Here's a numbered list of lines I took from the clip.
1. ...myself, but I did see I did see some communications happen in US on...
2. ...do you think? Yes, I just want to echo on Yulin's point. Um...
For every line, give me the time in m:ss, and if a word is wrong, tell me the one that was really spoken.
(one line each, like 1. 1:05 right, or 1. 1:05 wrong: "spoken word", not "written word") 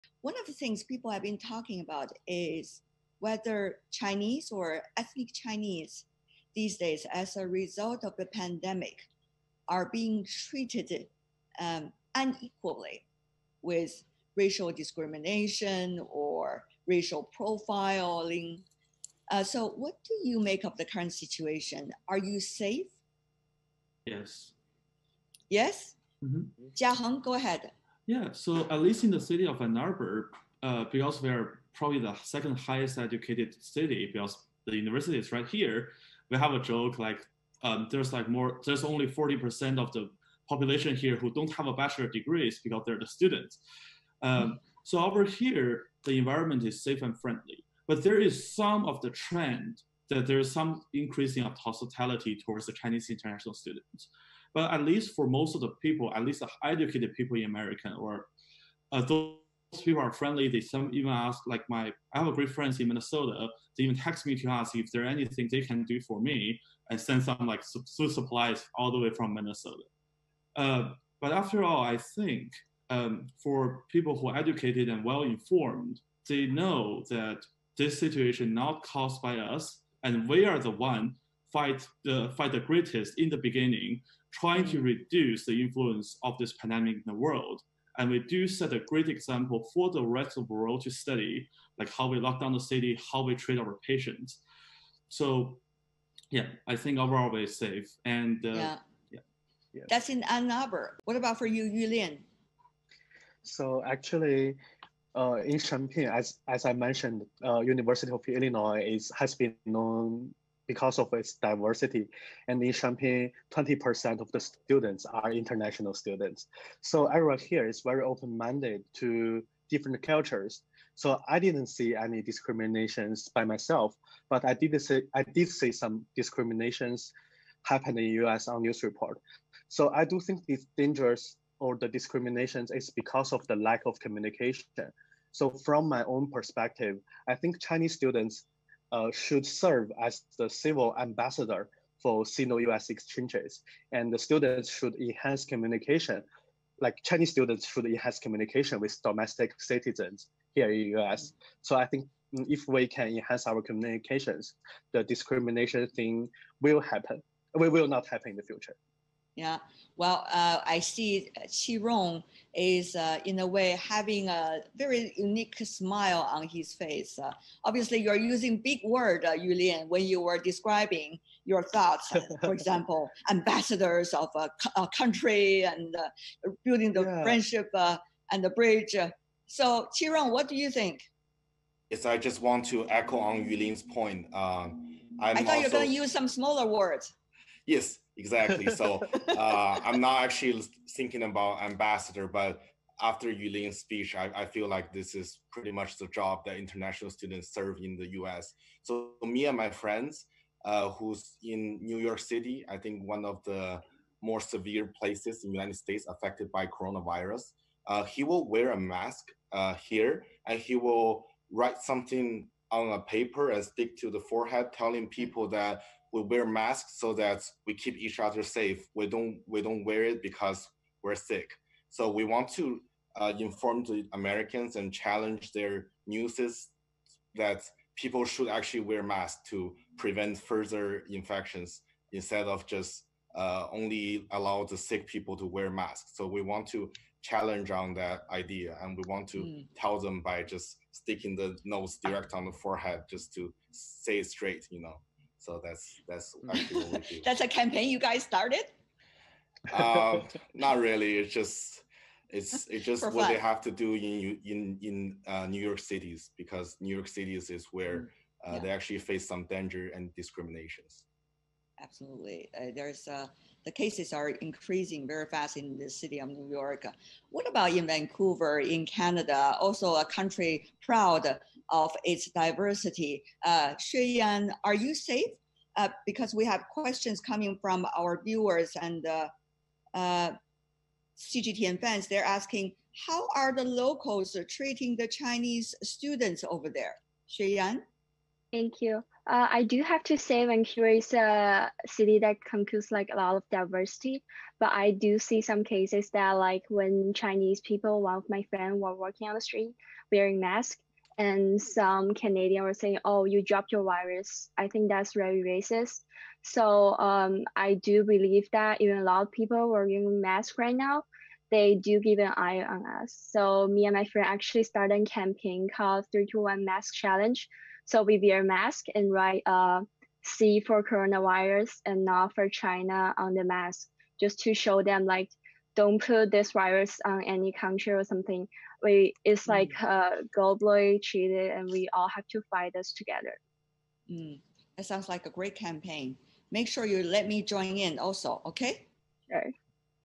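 1. 2:03 wrong: "discriminations", not "communications"
2. 3:00 right.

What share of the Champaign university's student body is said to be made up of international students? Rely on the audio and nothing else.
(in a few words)
20%.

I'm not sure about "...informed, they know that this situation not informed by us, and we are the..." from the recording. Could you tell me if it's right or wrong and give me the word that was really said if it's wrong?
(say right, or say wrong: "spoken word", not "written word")
wrong: "caused", not "informed".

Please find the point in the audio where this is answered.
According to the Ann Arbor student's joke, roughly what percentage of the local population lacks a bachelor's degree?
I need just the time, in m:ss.
0:39.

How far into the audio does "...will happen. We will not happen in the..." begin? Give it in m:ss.
2:36.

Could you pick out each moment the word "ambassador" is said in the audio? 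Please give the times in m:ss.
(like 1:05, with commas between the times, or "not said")
2:20, 2:53, 3:11.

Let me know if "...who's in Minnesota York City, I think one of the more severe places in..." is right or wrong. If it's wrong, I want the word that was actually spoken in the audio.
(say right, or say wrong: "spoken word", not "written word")
wrong: "New", not "Minnesota".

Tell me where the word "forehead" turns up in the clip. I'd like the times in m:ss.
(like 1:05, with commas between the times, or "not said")
3:34, 4:02.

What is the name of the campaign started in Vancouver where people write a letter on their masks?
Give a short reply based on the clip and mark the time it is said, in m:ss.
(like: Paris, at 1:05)
321 Mask Challenge, at 5:16.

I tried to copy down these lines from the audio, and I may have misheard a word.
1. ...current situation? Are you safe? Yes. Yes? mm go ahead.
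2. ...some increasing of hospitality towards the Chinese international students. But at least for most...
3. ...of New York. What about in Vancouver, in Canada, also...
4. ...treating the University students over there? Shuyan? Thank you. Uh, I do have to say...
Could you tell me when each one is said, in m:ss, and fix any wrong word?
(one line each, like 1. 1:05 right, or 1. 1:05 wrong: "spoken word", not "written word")
1. 0:20 right
2. 0:50 right
3. 4:26 right
4. 4:44 wrong: "Chinese", not "University".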